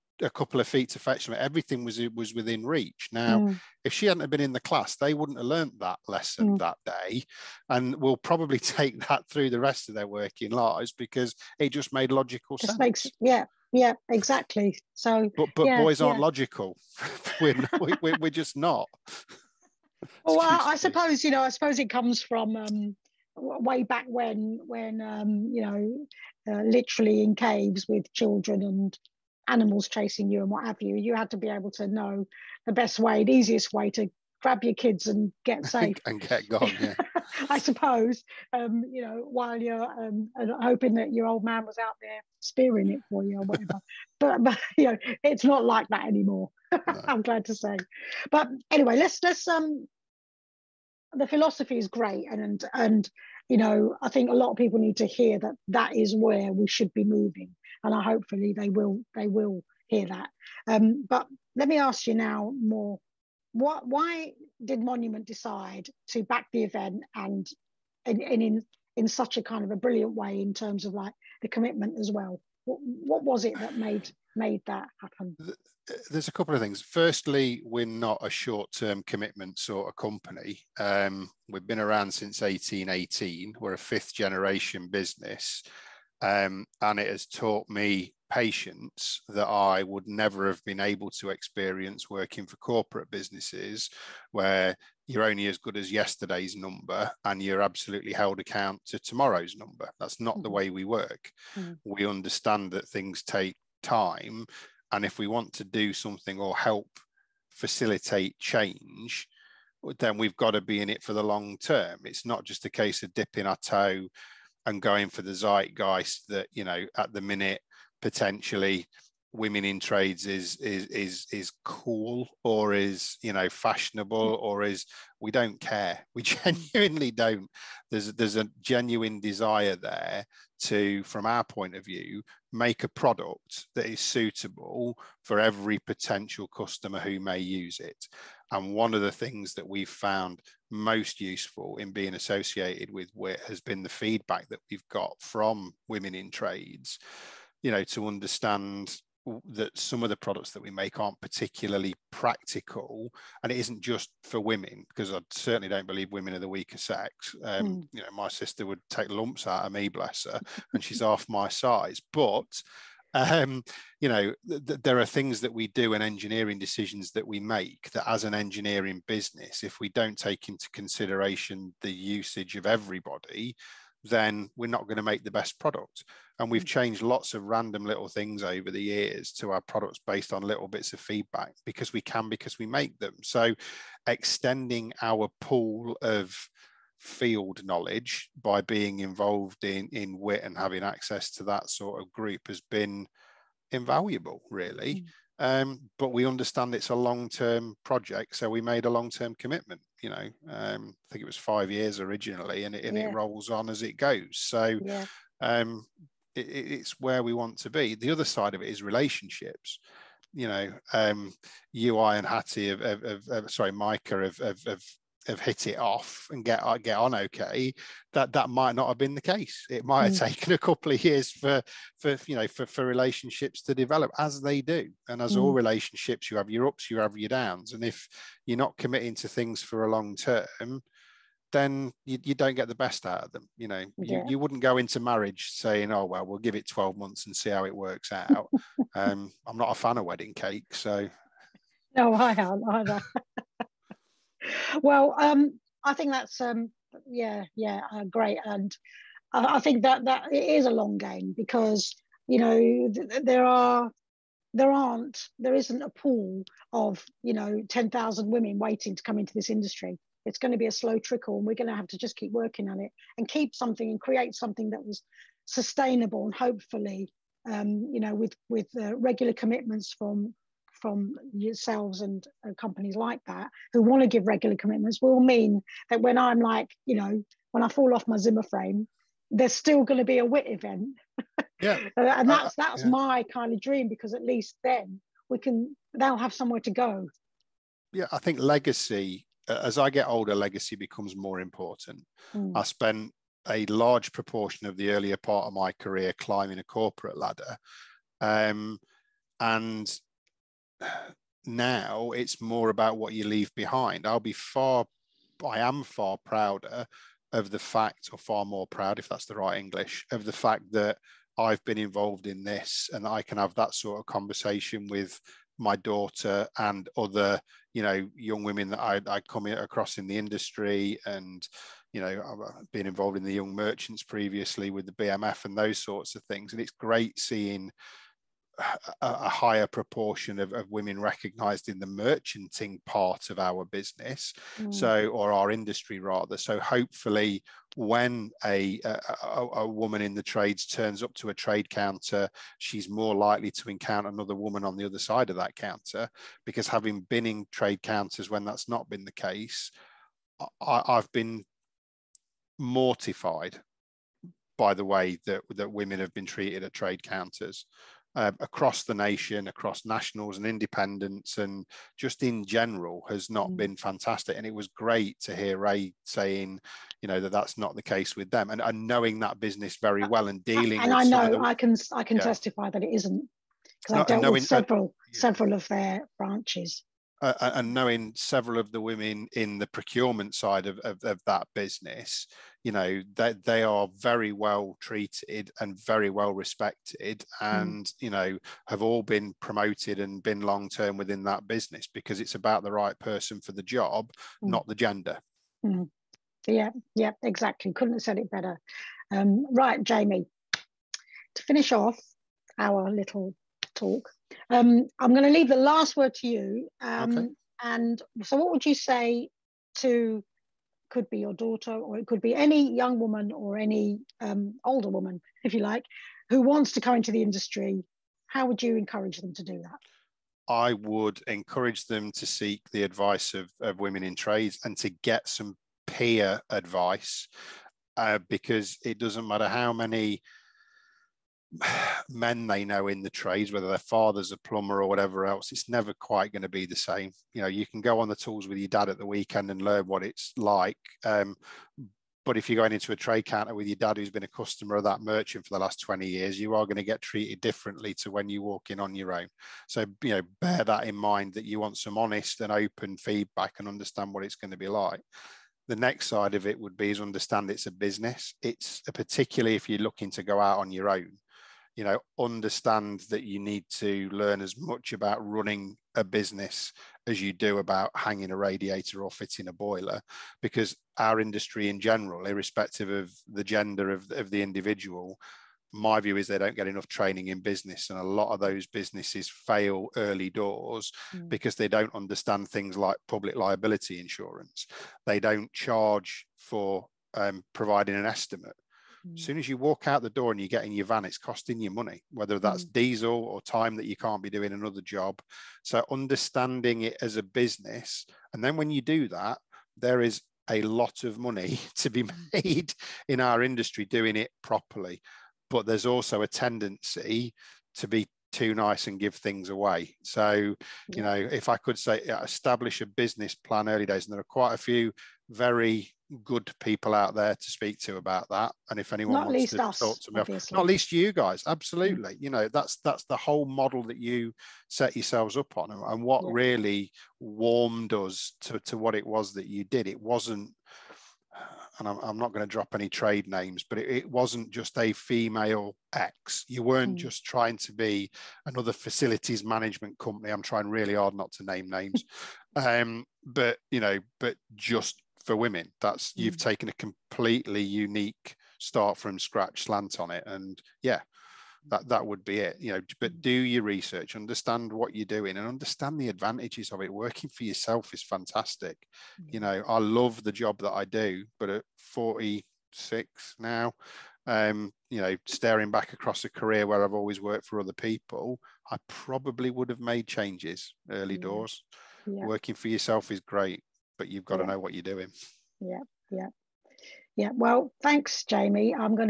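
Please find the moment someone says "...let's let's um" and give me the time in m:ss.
0:48.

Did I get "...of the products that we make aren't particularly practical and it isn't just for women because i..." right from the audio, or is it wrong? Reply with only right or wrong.
right.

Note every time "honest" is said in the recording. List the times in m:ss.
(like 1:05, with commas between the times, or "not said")
7:31.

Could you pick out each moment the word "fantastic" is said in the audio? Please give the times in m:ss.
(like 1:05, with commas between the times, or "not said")
6:03, 9:18.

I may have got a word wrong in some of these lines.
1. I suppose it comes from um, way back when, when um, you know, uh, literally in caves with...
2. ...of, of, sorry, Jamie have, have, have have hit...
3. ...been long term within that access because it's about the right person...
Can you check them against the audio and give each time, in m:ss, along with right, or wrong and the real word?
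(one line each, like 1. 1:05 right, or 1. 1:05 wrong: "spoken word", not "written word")
1. 0:21 right
2. 3:32 wrong: "Micah", not "Jamie"
3. 6:30 wrong: "business", not "access".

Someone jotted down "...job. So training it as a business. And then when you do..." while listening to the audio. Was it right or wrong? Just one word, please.
wrong.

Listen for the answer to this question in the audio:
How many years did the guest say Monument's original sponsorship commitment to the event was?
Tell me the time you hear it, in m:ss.
3:21.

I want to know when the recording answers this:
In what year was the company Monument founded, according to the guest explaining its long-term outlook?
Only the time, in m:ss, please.
1:22.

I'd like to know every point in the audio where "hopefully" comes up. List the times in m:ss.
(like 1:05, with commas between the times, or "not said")
0:58, 4:26, 5:36.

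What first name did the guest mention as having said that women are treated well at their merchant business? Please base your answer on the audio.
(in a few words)
Ray.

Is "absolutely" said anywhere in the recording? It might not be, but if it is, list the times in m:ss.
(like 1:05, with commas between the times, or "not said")
1:37, 8:41.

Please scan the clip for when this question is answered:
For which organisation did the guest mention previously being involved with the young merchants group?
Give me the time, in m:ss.
5:24.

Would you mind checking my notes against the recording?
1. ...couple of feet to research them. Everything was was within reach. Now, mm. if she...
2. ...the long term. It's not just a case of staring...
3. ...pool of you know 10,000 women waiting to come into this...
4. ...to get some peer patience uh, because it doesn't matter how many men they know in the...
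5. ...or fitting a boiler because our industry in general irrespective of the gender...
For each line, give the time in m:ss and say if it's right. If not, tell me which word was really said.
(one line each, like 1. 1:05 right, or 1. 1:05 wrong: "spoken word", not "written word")
1. 0:00 wrong: "fetch", not "research"
2. 1:51 wrong: "dipping", not "staring"
3. 4:15 right
4. 7:04 wrong: "advice", not "patience"
5. 7:49 right.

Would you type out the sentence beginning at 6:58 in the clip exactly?
How would you encourage them to do that?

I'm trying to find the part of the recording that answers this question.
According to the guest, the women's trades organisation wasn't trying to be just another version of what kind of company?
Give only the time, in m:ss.
8:58.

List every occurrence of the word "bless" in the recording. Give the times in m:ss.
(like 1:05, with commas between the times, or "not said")
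2:39.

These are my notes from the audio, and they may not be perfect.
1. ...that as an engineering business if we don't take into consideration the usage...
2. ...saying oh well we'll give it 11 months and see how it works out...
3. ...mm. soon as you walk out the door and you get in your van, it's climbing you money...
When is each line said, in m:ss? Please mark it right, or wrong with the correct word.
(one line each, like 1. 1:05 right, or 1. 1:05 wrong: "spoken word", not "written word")
1. 2:47 right
2. 3:55 wrong: "12", not "11"
3. 8:09 wrong: "costing", not "climbing".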